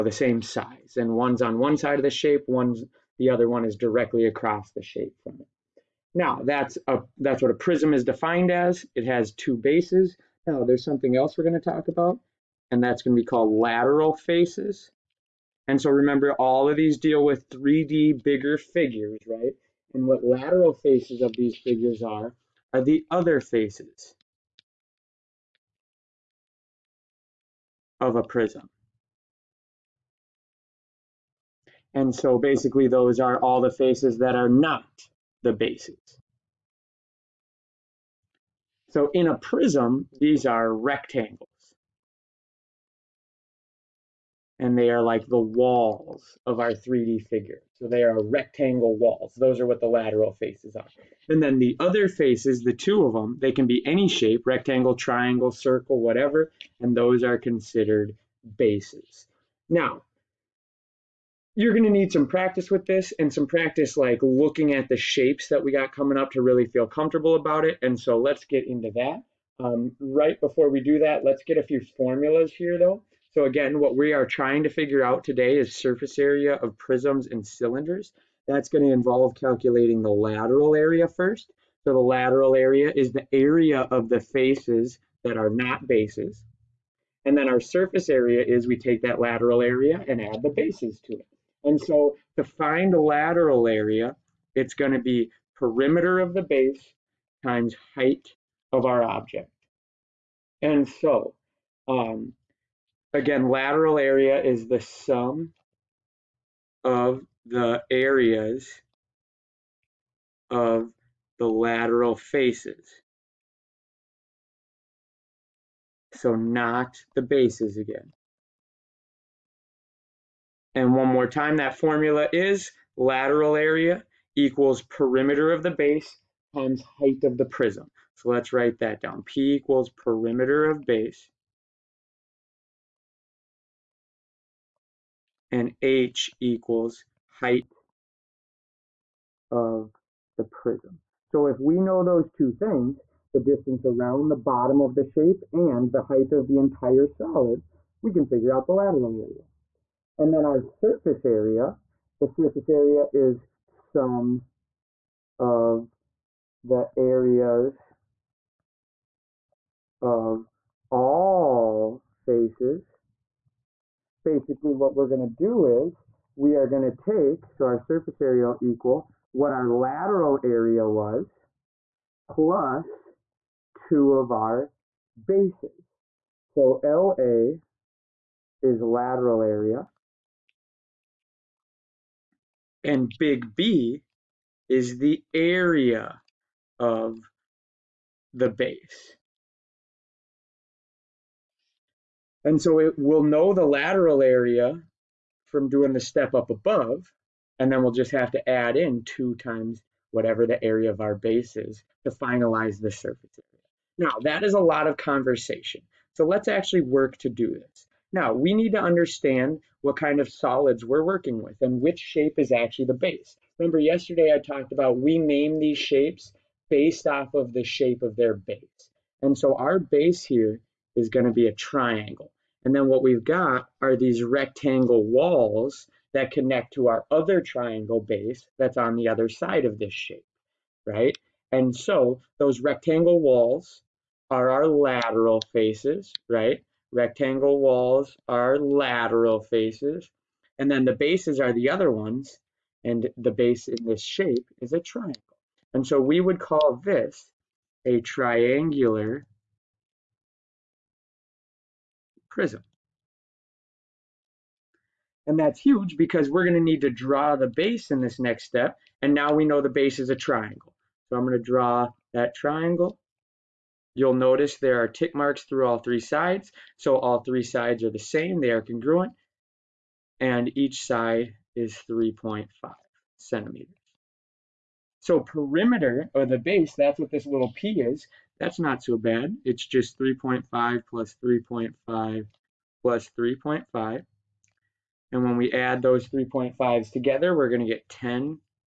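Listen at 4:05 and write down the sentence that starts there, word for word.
And so we would call this a triangular prism.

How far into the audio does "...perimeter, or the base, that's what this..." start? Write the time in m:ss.
4:35.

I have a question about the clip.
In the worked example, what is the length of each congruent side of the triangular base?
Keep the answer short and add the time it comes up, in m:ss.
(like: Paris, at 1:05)
3.5 centimeters, at 4:31.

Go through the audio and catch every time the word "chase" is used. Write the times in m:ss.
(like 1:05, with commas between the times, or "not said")
not said.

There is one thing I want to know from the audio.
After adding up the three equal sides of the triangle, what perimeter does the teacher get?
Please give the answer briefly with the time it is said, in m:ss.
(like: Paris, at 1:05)
10.5, at 4:47.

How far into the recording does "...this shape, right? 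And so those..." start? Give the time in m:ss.
3:49.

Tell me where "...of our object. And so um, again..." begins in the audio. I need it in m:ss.
1:38.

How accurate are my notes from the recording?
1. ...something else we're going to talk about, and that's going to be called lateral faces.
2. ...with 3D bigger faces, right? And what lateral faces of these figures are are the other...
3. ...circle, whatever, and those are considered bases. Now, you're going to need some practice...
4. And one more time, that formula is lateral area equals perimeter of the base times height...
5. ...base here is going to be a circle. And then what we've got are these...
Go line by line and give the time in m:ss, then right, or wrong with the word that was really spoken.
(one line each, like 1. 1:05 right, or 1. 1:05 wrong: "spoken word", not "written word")
1. 0:10 right
2. 0:17 wrong: "figures", not "faces"
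3. 0:55 right
4. 2:00 right
5. 3:39 wrong: "triangle", not "circle".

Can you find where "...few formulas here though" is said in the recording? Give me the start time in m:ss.
1:11.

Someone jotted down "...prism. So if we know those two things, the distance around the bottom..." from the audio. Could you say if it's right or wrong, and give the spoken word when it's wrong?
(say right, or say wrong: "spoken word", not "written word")
right.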